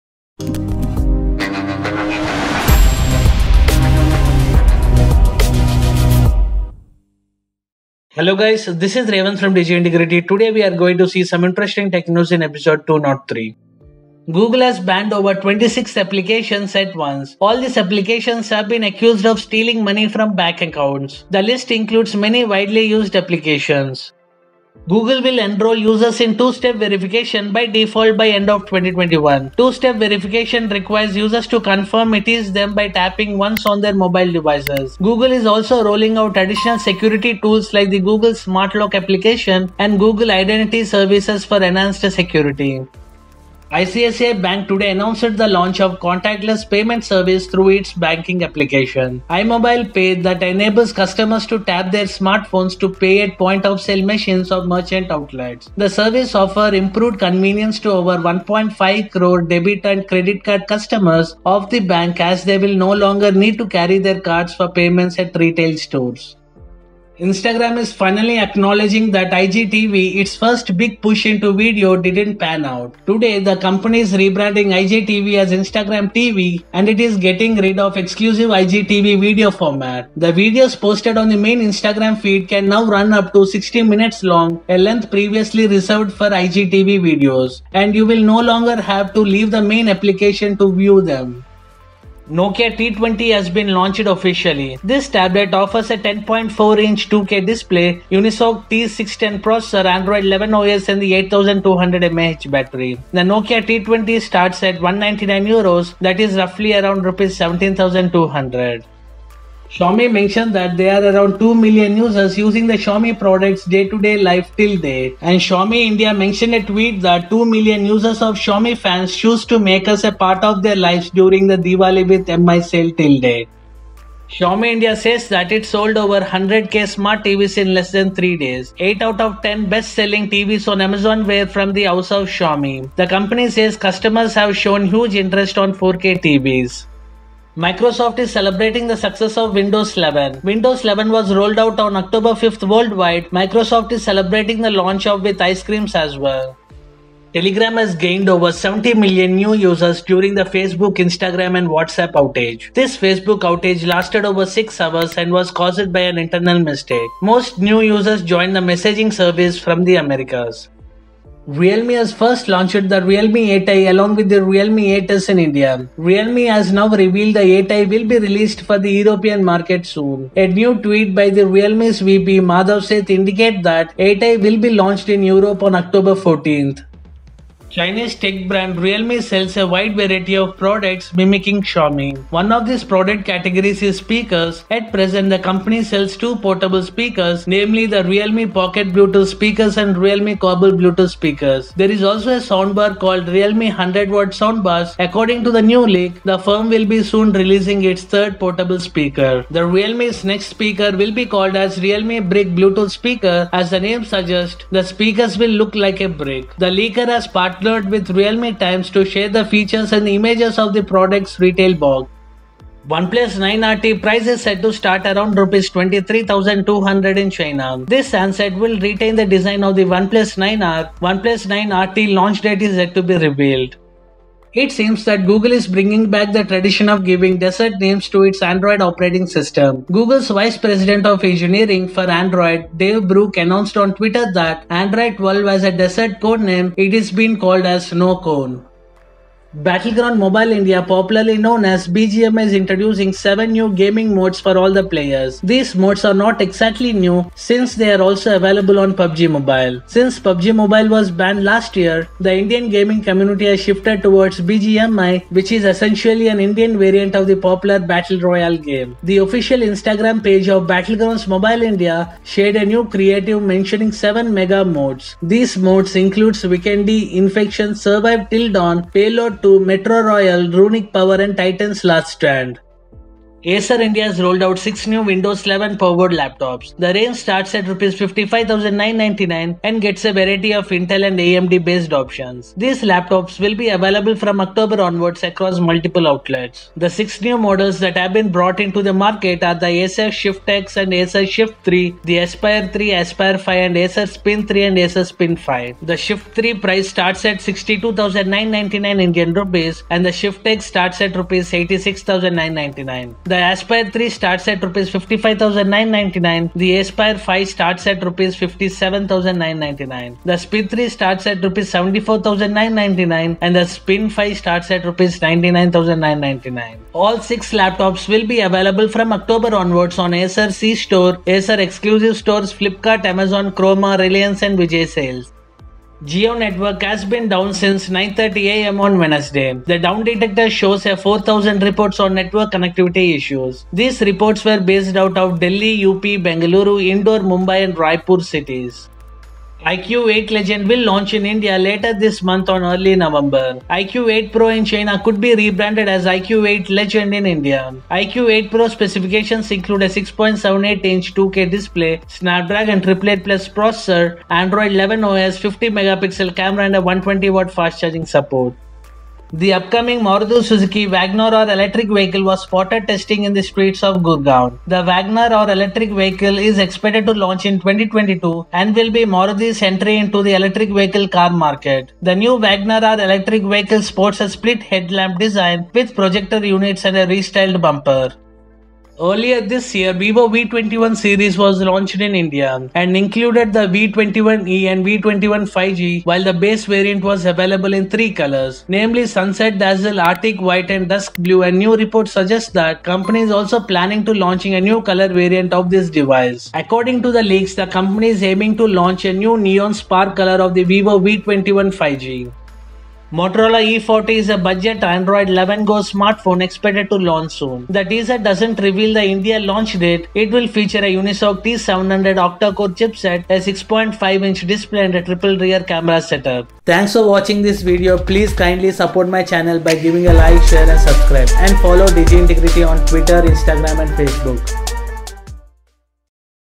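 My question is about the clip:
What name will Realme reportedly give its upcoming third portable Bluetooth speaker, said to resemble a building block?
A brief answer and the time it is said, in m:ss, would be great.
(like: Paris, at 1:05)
Realme Brick, at 3:21.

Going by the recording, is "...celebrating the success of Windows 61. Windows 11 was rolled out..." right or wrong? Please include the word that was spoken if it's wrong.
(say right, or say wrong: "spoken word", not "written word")
wrong: "11", not "61".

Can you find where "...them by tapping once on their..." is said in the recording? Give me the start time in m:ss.
0:32.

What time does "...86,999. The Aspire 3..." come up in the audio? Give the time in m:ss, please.
5:01.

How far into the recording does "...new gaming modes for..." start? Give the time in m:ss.
4:03.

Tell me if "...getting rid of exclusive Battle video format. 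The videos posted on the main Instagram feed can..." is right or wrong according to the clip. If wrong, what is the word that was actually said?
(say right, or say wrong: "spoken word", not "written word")
wrong: "IGTV", not "Battle".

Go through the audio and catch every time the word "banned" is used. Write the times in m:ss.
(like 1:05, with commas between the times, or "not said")
0:14, 4:11.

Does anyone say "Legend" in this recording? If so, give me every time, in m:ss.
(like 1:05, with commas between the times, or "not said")
5:40, 5:46.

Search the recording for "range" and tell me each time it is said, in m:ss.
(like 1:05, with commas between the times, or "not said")
4:36.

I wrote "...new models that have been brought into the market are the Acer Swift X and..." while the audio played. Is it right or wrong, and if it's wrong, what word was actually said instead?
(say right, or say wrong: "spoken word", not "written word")
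right.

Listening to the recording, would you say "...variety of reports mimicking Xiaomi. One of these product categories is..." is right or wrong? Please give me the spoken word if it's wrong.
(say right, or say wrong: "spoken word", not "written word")
wrong: "products", not "reports".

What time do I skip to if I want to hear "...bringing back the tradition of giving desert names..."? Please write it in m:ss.
3:45.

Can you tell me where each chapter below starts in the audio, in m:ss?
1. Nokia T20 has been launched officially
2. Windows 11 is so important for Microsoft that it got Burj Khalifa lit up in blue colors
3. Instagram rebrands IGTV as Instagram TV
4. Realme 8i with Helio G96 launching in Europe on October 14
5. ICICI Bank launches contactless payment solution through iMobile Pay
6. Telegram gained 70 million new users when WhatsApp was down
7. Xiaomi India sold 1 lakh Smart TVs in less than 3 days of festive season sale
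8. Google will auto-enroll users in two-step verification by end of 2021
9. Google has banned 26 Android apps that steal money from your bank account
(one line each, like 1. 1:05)
1. 1:32
2. 2:17
3. 1:07
4. 2:41
5. 0:43
6. 2:27
7. 2:04
8. 0:24
9. 0:14.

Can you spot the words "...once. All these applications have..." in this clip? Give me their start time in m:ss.
0:16.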